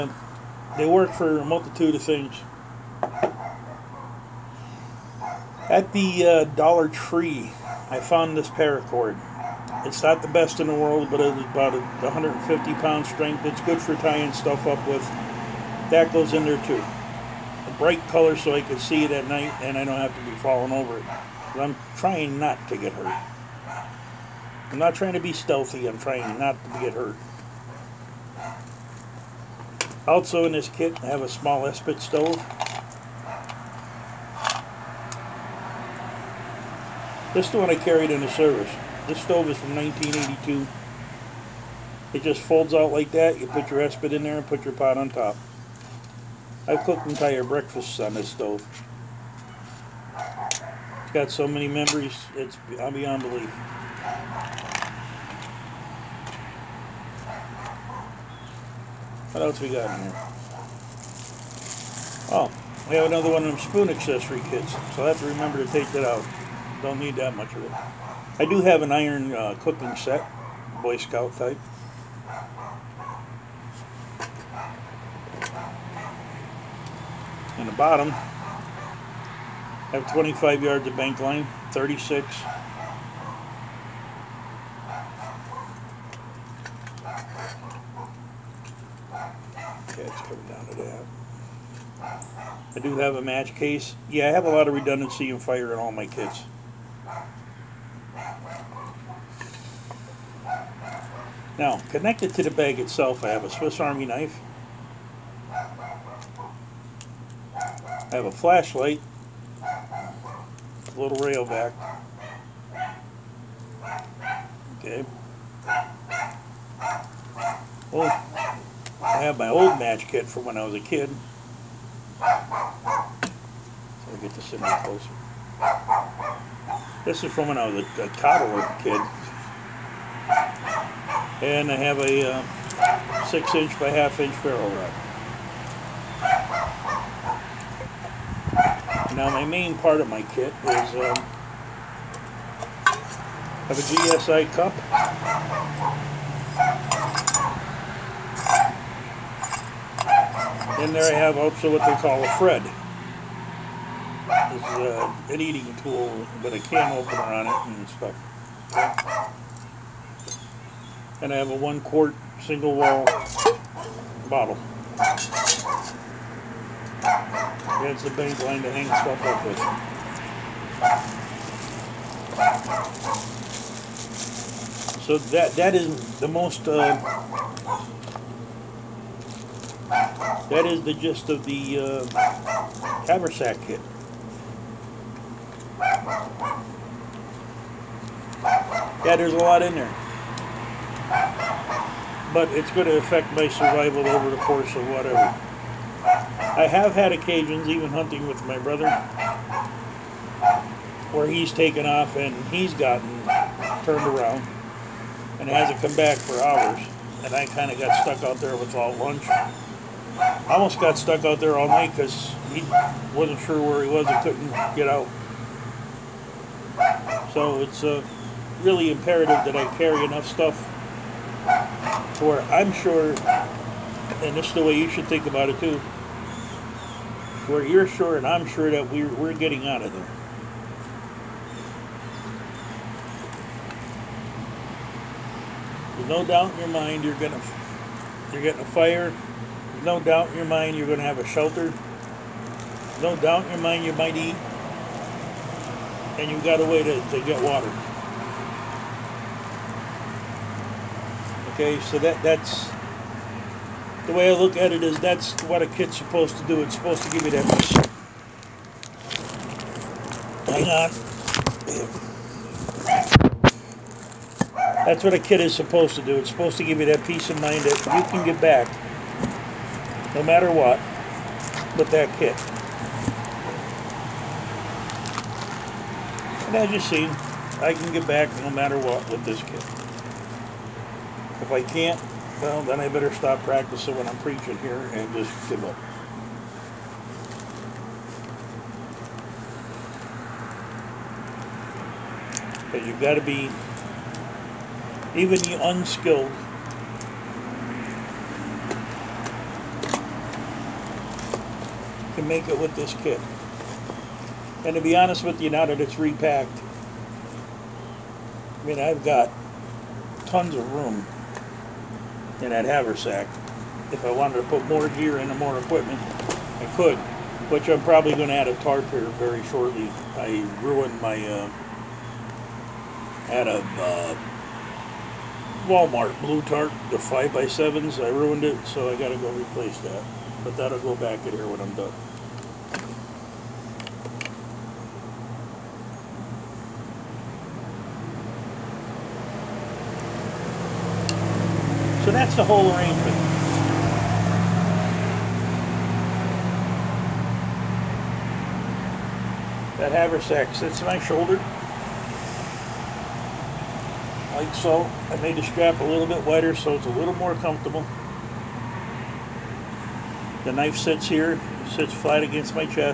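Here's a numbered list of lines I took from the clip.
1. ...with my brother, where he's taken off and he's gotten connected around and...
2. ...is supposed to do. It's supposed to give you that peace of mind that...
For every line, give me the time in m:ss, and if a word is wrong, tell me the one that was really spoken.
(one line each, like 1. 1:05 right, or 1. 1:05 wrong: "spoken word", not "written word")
1. 3:18 wrong: "turned", not "connected"
2. 4:25 right.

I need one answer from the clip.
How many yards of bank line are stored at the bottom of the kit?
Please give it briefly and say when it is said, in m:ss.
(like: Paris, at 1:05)
25 yards, at 1:20.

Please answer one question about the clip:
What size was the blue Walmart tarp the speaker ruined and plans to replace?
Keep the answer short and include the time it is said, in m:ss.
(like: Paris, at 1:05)
5x7, at 5:26.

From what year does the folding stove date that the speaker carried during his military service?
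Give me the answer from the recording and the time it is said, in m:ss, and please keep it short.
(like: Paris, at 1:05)
1982, at 0:39.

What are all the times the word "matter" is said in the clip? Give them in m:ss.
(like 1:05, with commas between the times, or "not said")
4:30, 4:38.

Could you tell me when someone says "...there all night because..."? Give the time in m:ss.
3:31.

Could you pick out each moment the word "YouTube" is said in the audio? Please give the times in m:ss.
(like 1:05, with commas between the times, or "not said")
not said.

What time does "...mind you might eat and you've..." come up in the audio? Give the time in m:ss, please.
4:03.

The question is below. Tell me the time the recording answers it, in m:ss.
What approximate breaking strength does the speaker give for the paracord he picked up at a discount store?
0:11.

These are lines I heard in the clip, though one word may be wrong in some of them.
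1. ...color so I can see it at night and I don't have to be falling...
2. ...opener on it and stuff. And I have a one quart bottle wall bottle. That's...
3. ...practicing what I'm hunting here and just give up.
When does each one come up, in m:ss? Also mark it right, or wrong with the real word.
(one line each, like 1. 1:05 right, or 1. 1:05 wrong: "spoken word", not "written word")
1. 0:18 right
2. 2:36 wrong: "single", not "bottle"
3. 4:43 wrong: "preaching", not "hunting".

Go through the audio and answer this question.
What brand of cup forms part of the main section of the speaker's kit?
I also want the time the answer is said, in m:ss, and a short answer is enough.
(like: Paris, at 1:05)
GSI, at 2:23.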